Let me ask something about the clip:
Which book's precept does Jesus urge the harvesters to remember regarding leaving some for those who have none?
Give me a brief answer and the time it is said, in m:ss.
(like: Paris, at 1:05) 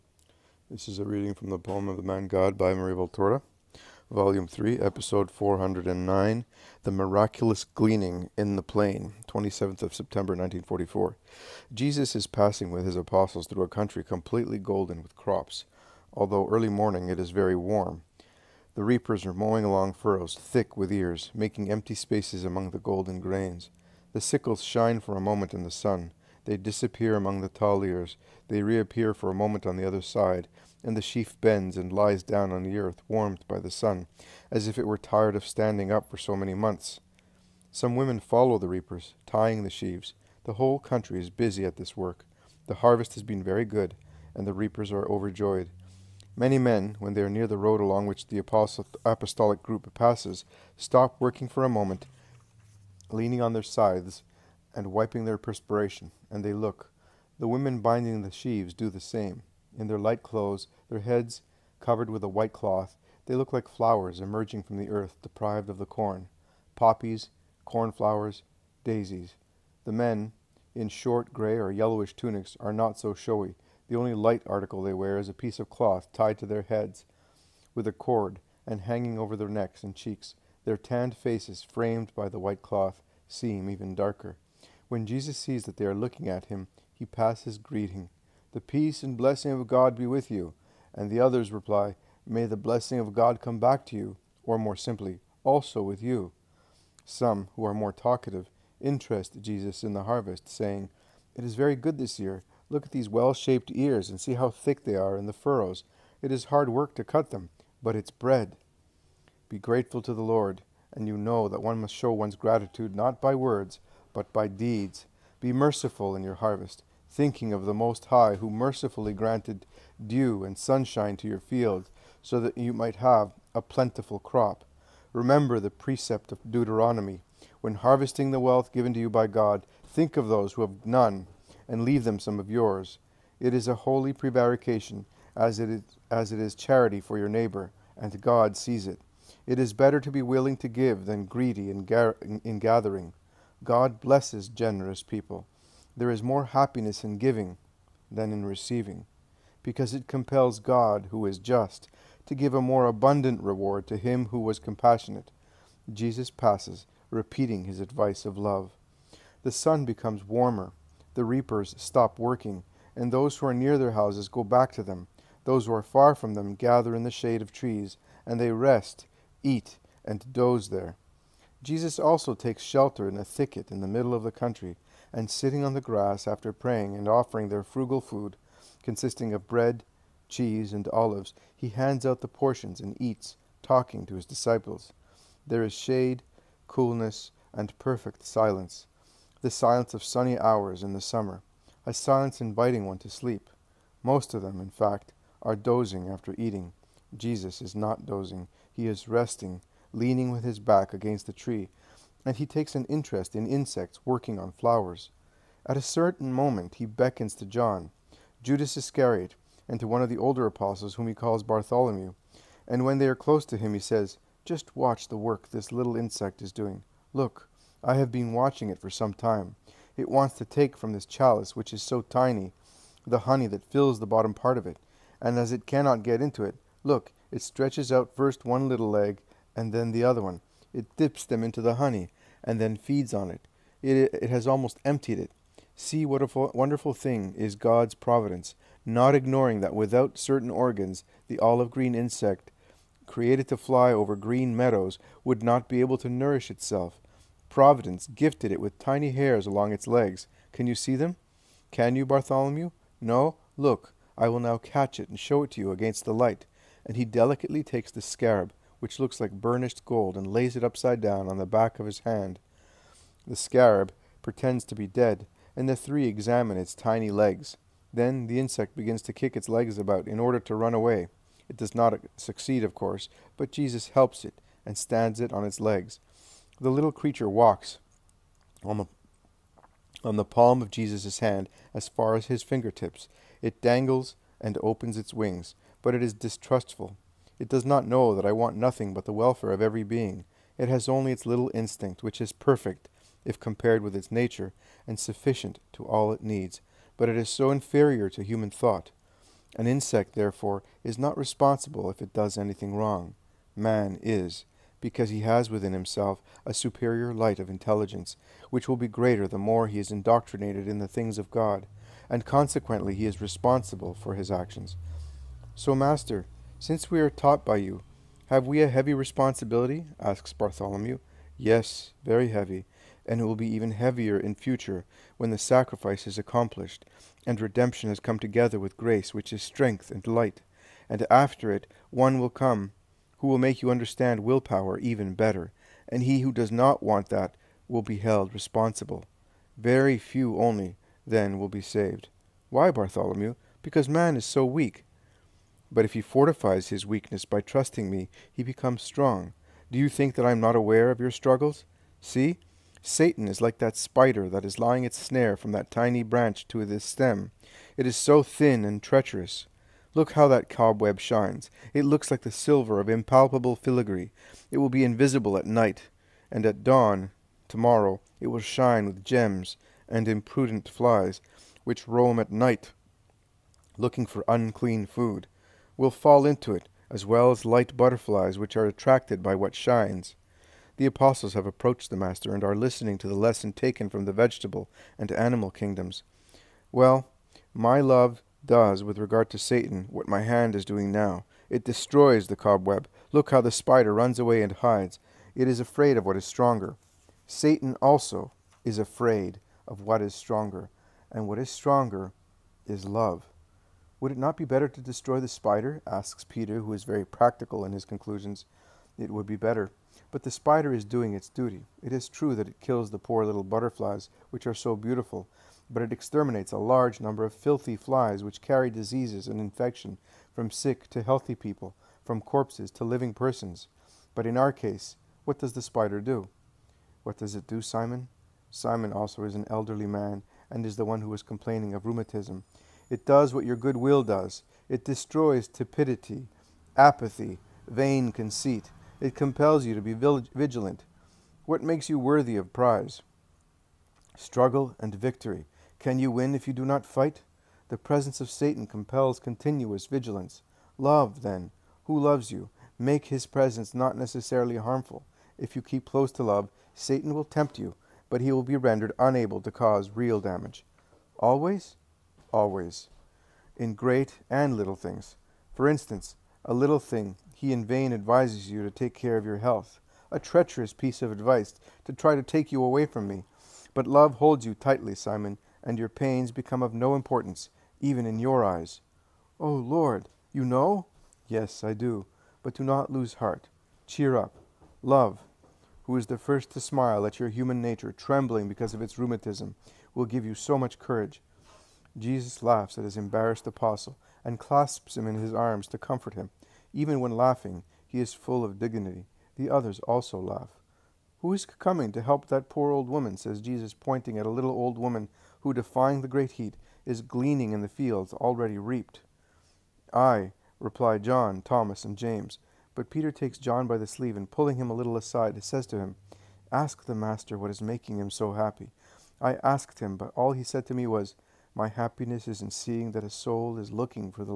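Deuteronomy, at 2:06.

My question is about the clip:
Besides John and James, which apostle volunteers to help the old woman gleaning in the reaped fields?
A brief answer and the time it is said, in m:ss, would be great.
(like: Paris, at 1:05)
Thomas, at 8:31.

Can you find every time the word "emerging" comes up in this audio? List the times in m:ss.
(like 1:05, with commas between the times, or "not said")
1:04.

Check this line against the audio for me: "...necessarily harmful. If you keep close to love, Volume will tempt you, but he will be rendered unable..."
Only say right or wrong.
wrong.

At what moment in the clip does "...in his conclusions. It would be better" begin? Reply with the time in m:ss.
6:47.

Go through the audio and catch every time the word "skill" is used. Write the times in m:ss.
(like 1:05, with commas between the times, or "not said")
not said.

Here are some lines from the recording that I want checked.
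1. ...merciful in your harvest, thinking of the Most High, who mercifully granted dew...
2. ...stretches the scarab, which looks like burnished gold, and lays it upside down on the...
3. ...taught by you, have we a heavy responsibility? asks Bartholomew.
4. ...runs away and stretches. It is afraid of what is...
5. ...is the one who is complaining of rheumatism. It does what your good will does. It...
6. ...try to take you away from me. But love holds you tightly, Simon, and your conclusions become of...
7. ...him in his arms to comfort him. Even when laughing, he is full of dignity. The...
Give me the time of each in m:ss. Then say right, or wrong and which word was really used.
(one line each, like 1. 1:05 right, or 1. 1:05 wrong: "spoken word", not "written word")
1. 1:55 right
2. 4:17 wrong: "takes", not "stretches"
3. 5:17 right
4. 6:33 wrong: "hides", not "stretches"
5. 7:10 right
6. 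7:51 wrong: "pains", not "conclusions"
7. 8:14 right.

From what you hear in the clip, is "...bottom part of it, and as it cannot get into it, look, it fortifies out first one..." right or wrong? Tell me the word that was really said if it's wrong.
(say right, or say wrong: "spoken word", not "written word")
wrong: "stretches", not "fortifies".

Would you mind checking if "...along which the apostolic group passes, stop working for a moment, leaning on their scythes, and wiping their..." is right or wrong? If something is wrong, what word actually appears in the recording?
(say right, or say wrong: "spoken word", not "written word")
right.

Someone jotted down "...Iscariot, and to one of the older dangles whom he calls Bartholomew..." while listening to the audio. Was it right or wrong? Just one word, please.
wrong.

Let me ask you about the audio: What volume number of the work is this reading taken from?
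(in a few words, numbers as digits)
3.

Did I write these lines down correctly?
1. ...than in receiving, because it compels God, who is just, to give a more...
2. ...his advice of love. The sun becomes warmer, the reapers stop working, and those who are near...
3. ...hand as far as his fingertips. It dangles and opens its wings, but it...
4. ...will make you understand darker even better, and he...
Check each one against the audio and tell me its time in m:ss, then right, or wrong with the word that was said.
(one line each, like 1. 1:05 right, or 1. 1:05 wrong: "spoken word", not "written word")
1. 2:28 right
2. 2:37 right
3. 4:41 right
4. 5:33 wrong: "willpower", not "darker".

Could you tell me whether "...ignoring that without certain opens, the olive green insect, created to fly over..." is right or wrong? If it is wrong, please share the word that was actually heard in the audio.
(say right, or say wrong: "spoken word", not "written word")
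wrong: "organs", not "opens".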